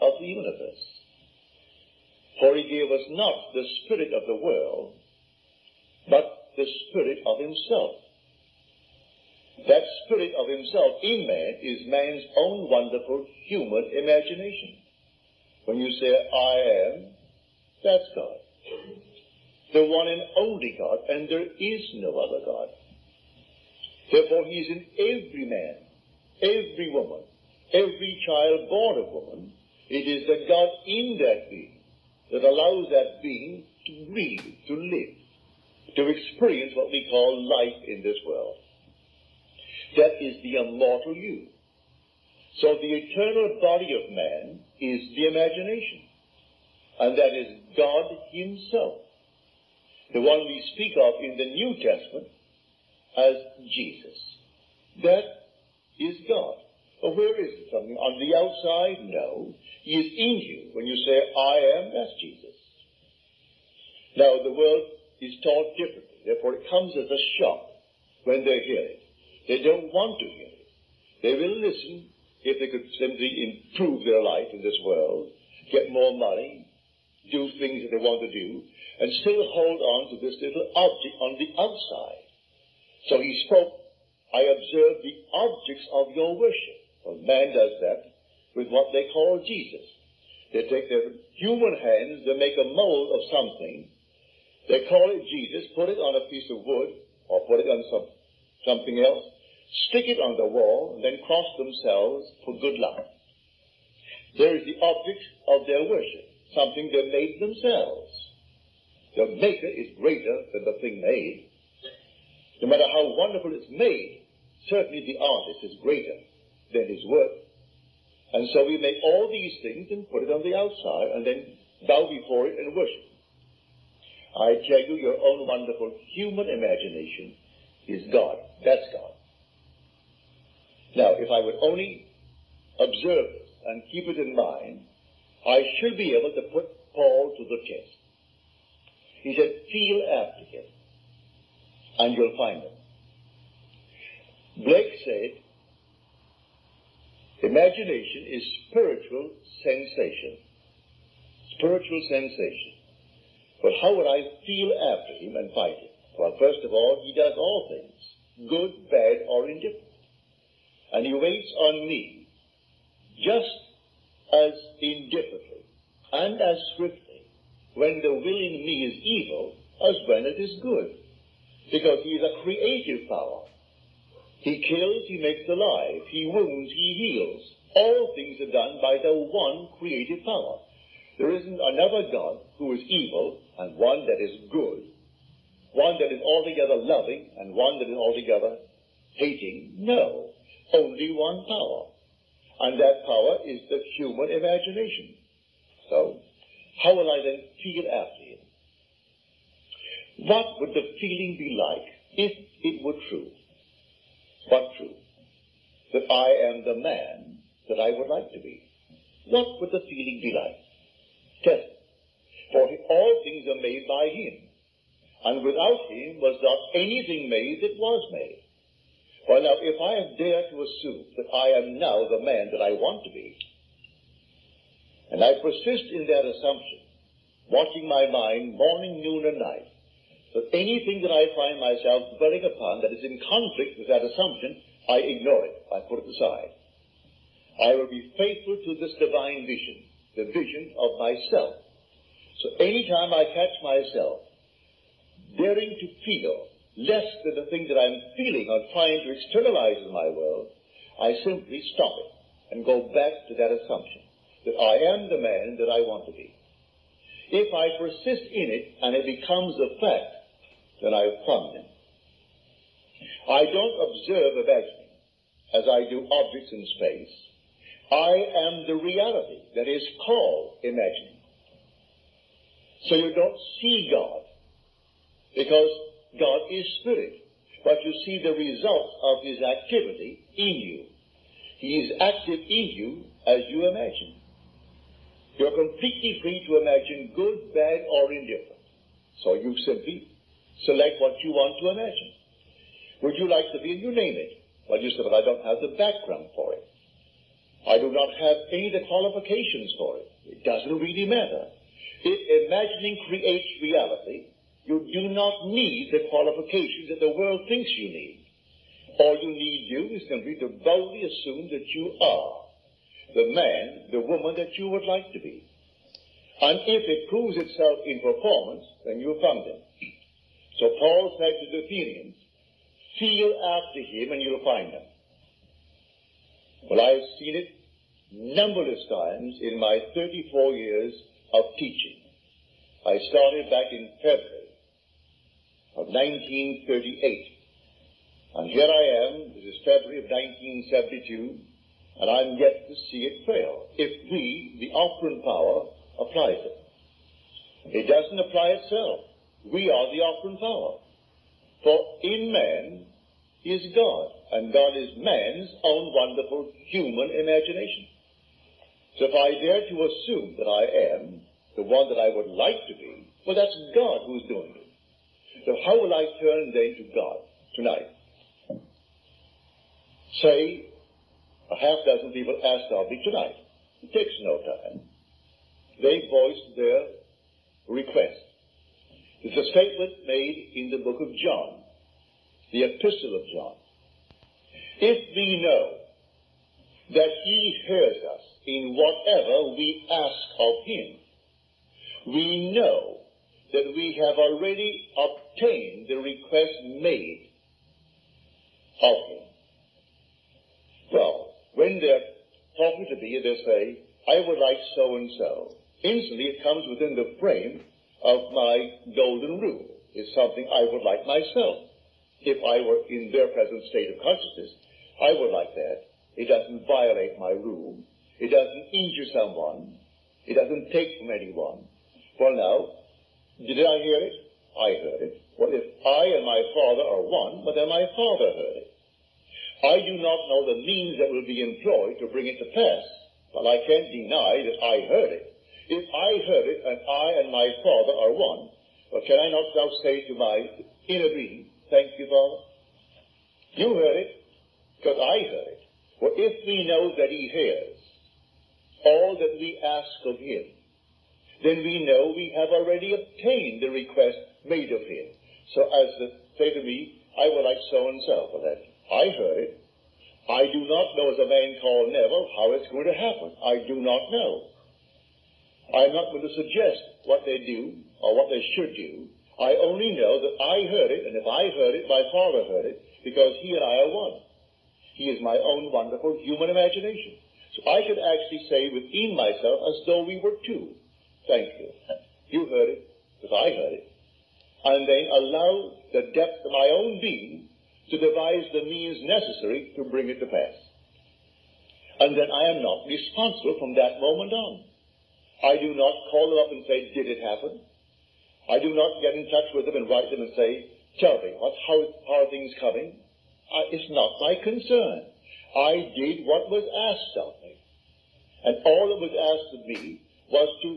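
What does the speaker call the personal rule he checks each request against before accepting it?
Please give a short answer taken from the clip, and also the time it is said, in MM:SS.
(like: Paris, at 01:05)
Golden rule, at 06:48.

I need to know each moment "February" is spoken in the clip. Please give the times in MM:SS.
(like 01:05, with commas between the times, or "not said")
05:34, 05:39.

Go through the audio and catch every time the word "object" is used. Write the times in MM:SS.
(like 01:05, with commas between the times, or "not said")
01:20, 01:25, 01:44, 04:26.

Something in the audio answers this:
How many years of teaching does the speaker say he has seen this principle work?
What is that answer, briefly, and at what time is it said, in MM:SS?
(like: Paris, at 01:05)
34, at 05:29.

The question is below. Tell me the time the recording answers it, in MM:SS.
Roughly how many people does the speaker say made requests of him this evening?
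06:11.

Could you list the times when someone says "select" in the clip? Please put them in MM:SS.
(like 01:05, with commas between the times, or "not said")
04:50.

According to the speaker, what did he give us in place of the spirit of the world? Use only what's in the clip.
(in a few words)
The Spirit of Himself.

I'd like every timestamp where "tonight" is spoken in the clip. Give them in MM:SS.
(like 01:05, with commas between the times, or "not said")
06:07, 06:13.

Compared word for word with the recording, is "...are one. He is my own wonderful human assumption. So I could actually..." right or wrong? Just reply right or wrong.
wrong.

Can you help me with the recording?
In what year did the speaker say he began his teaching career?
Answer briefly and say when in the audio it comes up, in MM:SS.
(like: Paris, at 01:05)
1938, at 05:35.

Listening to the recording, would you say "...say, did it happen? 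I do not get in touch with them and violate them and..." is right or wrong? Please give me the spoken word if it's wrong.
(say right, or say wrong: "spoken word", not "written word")
wrong: "write", not "violate".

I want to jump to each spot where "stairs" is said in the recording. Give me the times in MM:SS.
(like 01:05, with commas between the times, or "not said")
not said.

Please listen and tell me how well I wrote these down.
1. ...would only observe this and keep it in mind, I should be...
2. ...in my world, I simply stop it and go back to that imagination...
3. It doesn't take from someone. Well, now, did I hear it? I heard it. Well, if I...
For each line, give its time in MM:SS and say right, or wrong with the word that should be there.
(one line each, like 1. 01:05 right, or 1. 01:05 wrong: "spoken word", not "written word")
1. 02:11 right
2. 04:09 wrong: "assumption", not "imagination"
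3. 07:00 wrong: "anyone", not "someone".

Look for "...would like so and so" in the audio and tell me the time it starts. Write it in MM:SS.
06:44.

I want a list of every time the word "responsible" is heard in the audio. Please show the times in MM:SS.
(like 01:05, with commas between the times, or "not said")
08:12.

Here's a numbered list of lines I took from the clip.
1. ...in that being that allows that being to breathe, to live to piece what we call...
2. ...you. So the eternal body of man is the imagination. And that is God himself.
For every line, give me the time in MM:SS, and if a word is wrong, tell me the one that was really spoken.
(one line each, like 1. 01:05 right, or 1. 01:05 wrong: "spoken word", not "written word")
1. 00:30 wrong: "experience", not "piece"
2. 00:41 right.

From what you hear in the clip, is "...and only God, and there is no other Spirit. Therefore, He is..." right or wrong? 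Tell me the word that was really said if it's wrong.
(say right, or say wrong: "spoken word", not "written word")
wrong: "God", not "Spirit".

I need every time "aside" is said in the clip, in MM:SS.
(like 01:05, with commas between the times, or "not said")
03:56.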